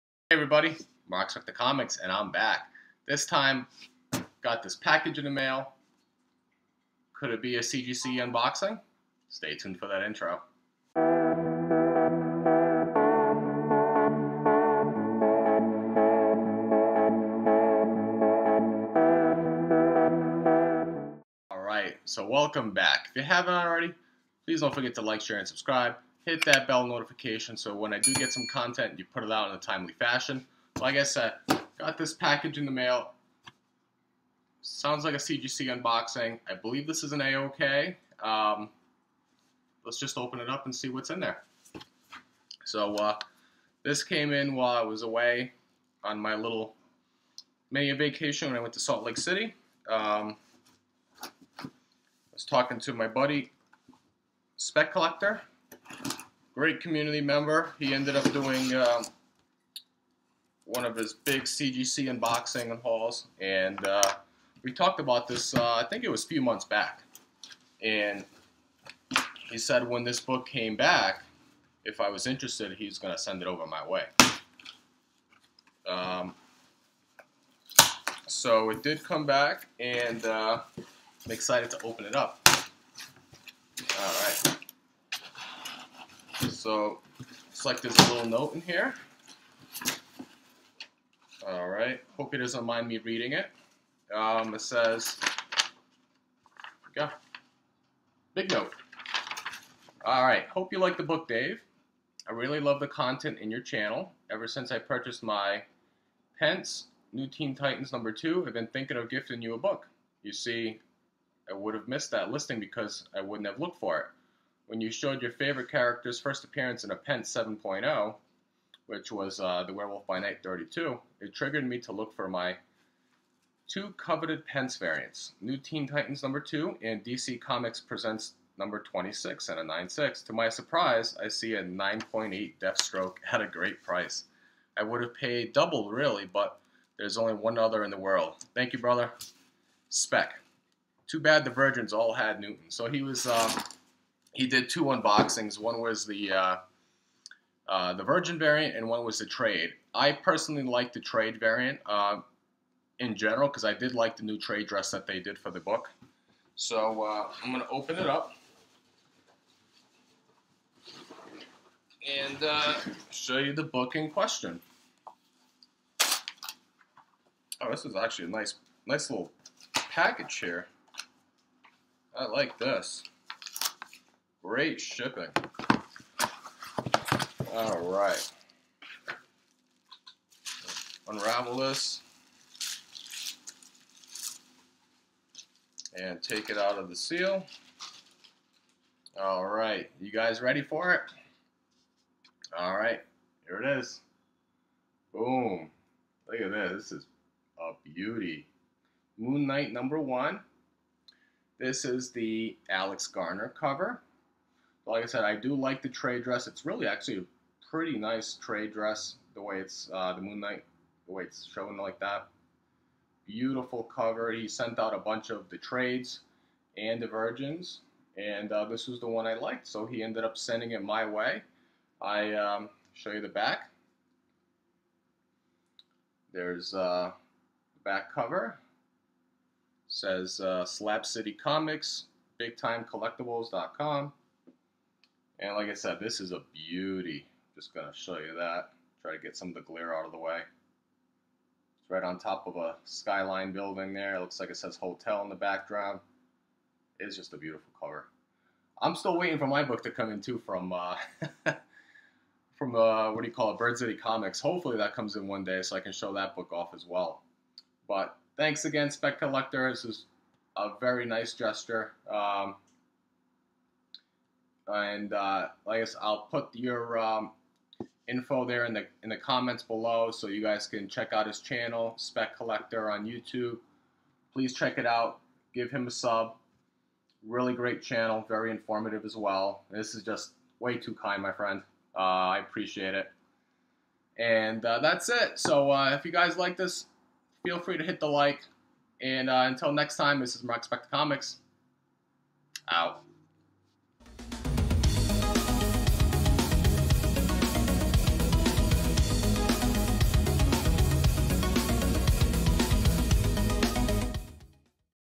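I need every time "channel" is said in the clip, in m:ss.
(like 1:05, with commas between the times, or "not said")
1:43, 4:31, 4:37.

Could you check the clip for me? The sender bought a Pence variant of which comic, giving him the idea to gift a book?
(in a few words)
New Teen Titans number 2.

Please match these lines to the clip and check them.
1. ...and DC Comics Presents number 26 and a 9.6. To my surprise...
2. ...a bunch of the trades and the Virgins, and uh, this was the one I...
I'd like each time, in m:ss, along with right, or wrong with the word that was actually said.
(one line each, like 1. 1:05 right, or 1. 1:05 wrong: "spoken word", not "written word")
1. 2:06 right
2. 3:34 right.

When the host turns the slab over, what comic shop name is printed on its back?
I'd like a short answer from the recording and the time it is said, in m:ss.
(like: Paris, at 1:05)
Slab City Comics, at 3:50.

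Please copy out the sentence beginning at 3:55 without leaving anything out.
And like I said, this is a beauty.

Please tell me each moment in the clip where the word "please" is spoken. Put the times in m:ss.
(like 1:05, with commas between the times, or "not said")
0:24, 4:34.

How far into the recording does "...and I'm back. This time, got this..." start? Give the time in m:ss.
0:01.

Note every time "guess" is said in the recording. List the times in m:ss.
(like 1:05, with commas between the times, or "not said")
4:25.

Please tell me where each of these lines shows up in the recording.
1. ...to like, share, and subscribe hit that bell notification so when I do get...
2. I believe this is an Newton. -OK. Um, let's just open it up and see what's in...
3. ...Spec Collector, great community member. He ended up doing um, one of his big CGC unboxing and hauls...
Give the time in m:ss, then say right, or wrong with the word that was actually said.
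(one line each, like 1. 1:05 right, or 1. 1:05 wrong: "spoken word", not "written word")
1. 0:24 right
2. 0:36 wrong: "AOK", not "Newton"
3. 0:54 right.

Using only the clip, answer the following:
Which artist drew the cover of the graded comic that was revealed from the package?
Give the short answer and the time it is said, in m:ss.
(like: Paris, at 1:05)
Alex Garner, at 3:22.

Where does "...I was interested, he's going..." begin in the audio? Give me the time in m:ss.
1:11.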